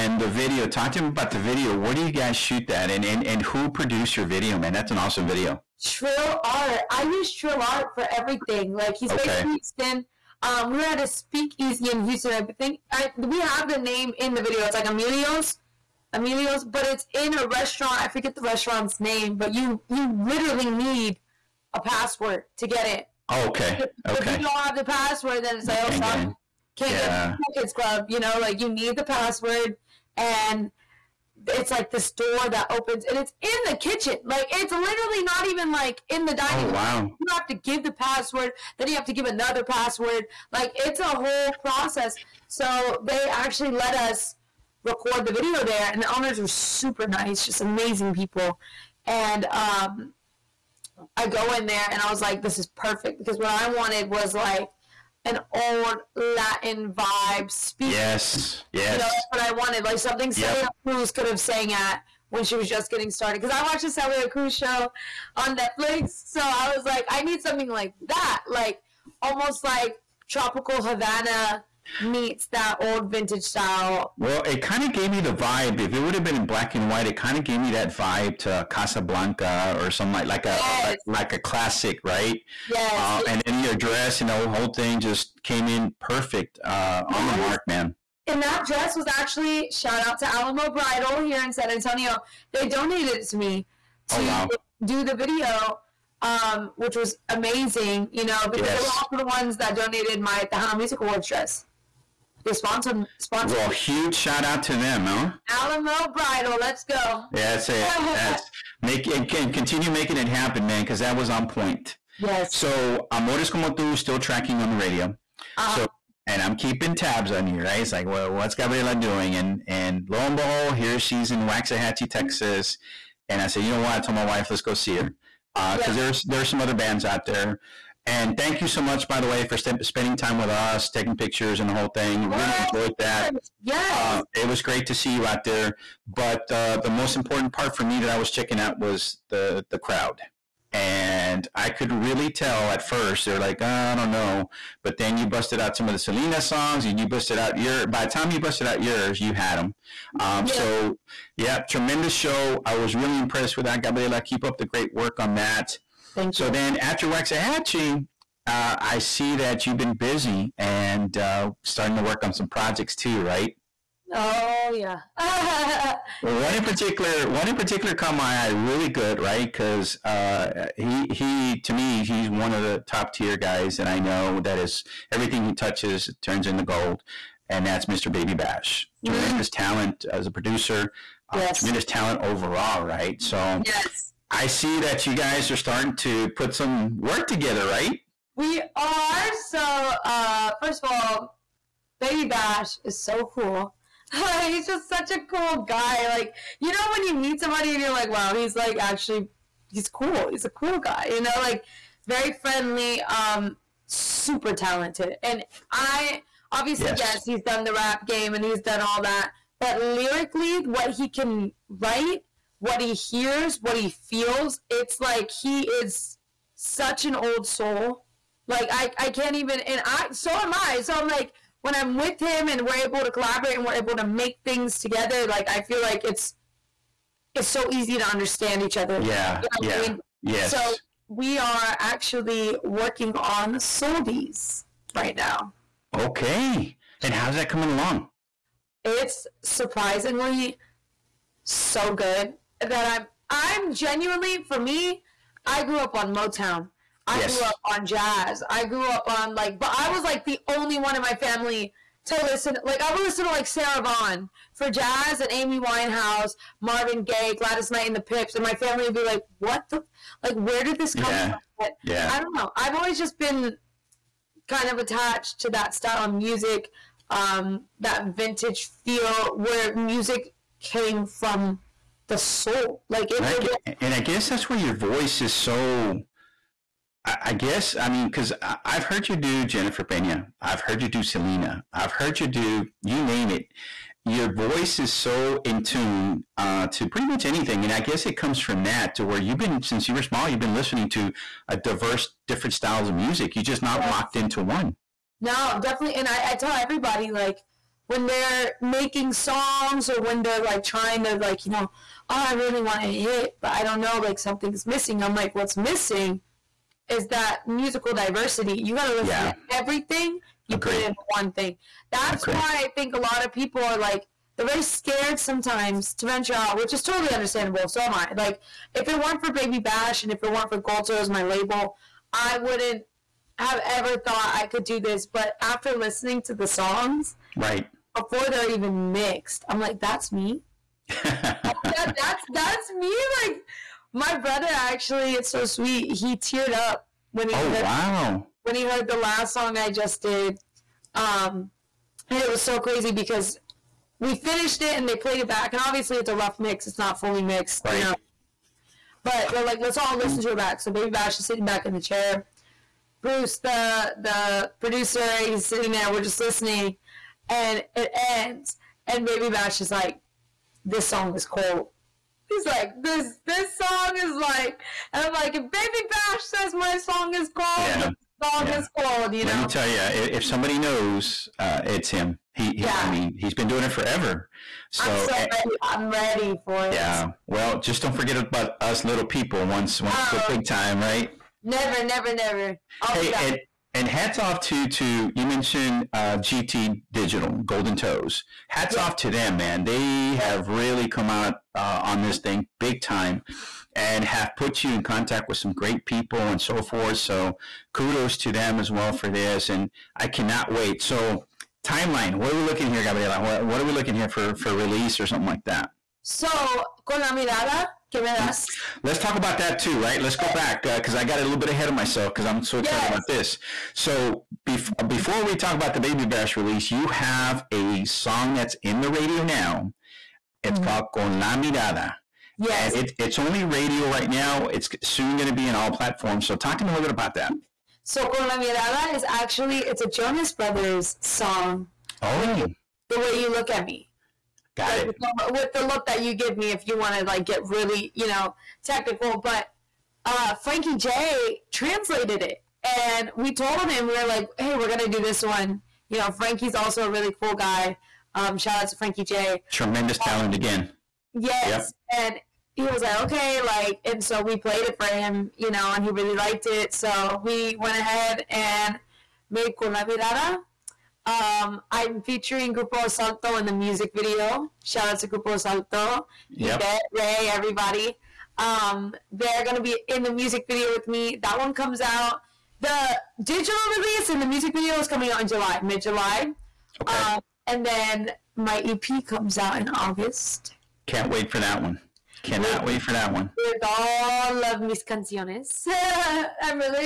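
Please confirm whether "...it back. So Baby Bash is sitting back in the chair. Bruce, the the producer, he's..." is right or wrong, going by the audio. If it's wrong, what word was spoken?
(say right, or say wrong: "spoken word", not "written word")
right.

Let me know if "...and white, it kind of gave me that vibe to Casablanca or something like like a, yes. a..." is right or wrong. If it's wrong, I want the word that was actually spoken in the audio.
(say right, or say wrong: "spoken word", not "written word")
right.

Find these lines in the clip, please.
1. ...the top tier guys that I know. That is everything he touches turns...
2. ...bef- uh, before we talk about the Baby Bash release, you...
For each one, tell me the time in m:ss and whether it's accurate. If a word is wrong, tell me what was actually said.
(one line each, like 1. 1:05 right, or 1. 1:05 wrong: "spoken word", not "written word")
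1. 2:52 right
2. 6:54 right.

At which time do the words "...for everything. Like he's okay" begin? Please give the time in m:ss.
0:07.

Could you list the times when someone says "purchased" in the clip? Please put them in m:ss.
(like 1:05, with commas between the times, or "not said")
not said.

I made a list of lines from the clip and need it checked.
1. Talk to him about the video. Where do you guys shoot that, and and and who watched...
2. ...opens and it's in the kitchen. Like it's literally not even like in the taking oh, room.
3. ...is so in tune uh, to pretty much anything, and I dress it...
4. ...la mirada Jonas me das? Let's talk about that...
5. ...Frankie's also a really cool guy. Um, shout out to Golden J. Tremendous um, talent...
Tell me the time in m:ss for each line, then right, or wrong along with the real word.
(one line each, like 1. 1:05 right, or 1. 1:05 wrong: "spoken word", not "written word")
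1. 0:00 wrong: "produced", not "watched"
2. 0:32 wrong: "dining", not "taking"
3. 4:44 wrong: "guess", not "dress"
4. 6:47 wrong: "Give", not "Jonas"
5. 7:26 wrong: "Frankie", not "Golden".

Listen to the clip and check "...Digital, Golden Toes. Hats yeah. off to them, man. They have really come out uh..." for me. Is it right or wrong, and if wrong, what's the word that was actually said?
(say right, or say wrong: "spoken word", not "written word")
right.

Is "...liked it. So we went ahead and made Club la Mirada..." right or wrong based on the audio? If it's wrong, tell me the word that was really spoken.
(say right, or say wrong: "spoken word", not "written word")
wrong: "Con", not "Club".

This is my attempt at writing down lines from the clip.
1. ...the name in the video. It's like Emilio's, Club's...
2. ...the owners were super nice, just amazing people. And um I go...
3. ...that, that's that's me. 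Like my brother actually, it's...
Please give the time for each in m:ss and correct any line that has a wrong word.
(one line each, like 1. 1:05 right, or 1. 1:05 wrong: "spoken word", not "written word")
1. 0:13 wrong: "Emilio", not "Club"
2. 0:46 right
3. 5:31 right.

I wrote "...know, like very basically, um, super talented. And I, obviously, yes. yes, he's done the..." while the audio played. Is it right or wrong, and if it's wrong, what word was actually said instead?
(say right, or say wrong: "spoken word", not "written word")
wrong: "friendly", not "basically".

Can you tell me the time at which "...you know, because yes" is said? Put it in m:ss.
1:38.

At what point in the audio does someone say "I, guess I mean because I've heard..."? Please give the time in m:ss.
4:37.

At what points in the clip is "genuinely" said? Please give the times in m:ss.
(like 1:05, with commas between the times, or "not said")
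4:03.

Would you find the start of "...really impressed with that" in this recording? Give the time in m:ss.
2:32.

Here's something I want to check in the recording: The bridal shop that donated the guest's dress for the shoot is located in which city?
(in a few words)
San Antonio.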